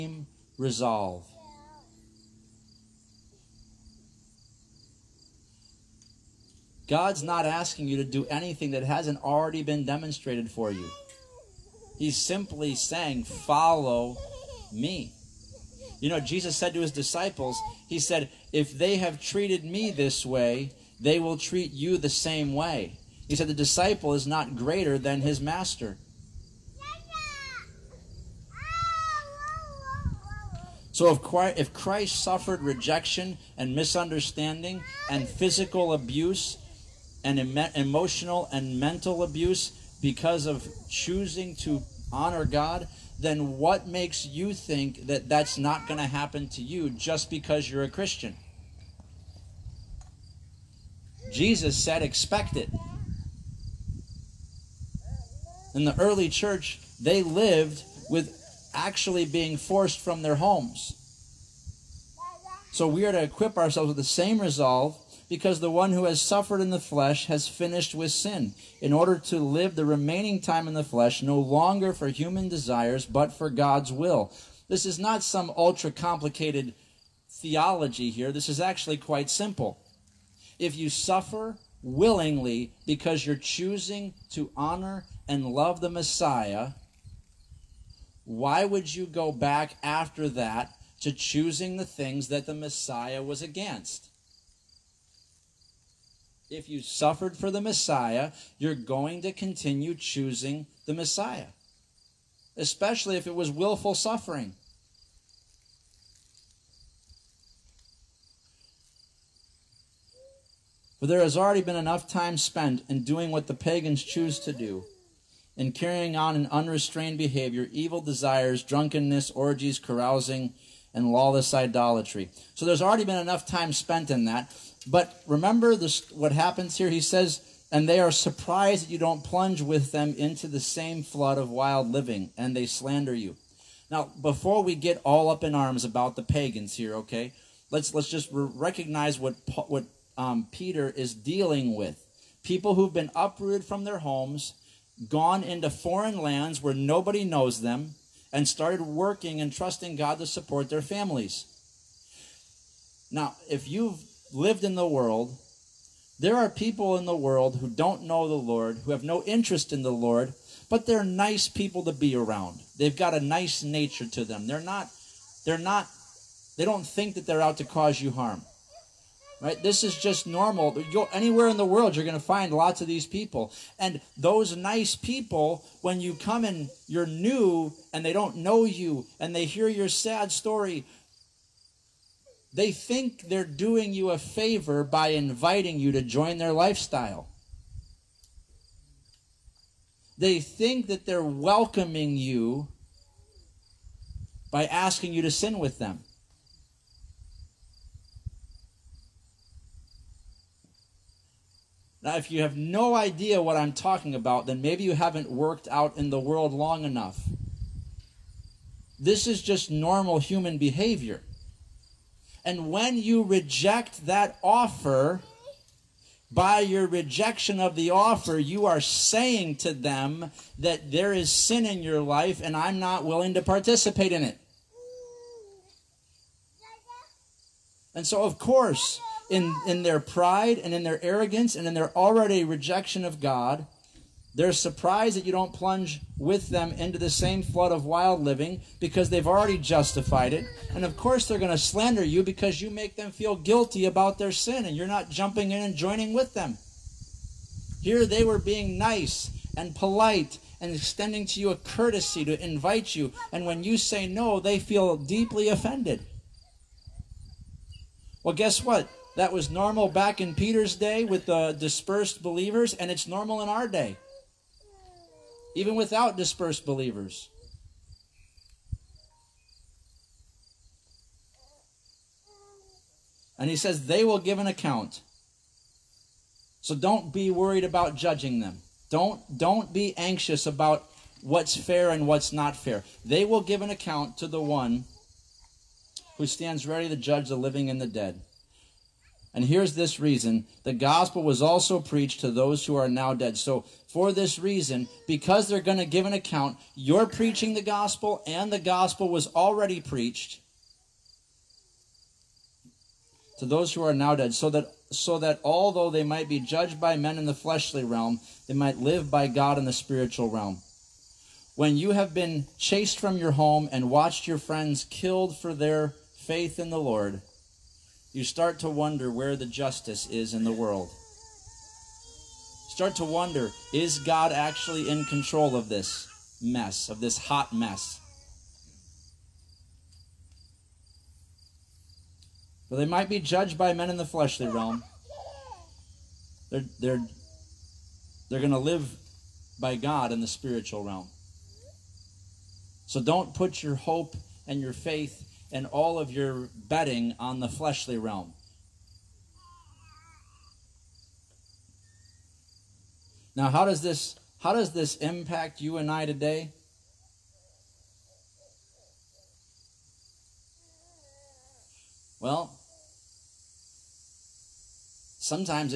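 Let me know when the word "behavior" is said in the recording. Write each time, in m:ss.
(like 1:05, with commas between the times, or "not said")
1:57, 3:30.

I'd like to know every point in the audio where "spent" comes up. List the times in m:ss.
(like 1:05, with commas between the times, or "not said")
1:52, 2:03.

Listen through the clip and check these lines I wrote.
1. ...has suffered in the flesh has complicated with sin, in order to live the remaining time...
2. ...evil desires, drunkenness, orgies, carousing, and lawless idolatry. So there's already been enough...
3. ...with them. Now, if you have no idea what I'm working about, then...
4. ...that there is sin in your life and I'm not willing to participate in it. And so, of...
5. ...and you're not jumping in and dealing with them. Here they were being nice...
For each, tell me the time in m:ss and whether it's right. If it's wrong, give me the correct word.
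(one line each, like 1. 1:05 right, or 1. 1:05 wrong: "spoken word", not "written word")
1. 1:06 wrong: "finished", not "complicated"
2. 1:57 right
3. 3:15 wrong: "talking", not "working"
4. 3:40 right
5. 4:04 wrong: "joining", not "dealing".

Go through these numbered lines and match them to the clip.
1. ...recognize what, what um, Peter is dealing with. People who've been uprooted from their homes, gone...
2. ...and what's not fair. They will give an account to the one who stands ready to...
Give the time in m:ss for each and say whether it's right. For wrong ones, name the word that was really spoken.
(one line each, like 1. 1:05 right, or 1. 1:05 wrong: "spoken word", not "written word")
1. 2:18 right
2. 4:41 right.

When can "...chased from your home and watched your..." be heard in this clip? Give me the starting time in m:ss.
5:12.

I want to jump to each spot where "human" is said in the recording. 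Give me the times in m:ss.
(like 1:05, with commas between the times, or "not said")
1:12, 3:30.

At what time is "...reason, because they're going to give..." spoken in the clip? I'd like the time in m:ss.
4:54.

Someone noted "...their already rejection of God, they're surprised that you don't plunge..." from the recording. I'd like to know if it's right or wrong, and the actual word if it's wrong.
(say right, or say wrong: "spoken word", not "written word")
right.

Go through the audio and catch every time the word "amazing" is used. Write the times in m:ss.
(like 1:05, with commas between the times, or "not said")
not said.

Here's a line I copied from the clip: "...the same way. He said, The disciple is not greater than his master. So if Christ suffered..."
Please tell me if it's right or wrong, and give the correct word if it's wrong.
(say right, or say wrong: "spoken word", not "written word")
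right.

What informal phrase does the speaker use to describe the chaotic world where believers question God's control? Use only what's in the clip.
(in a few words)
hot mess.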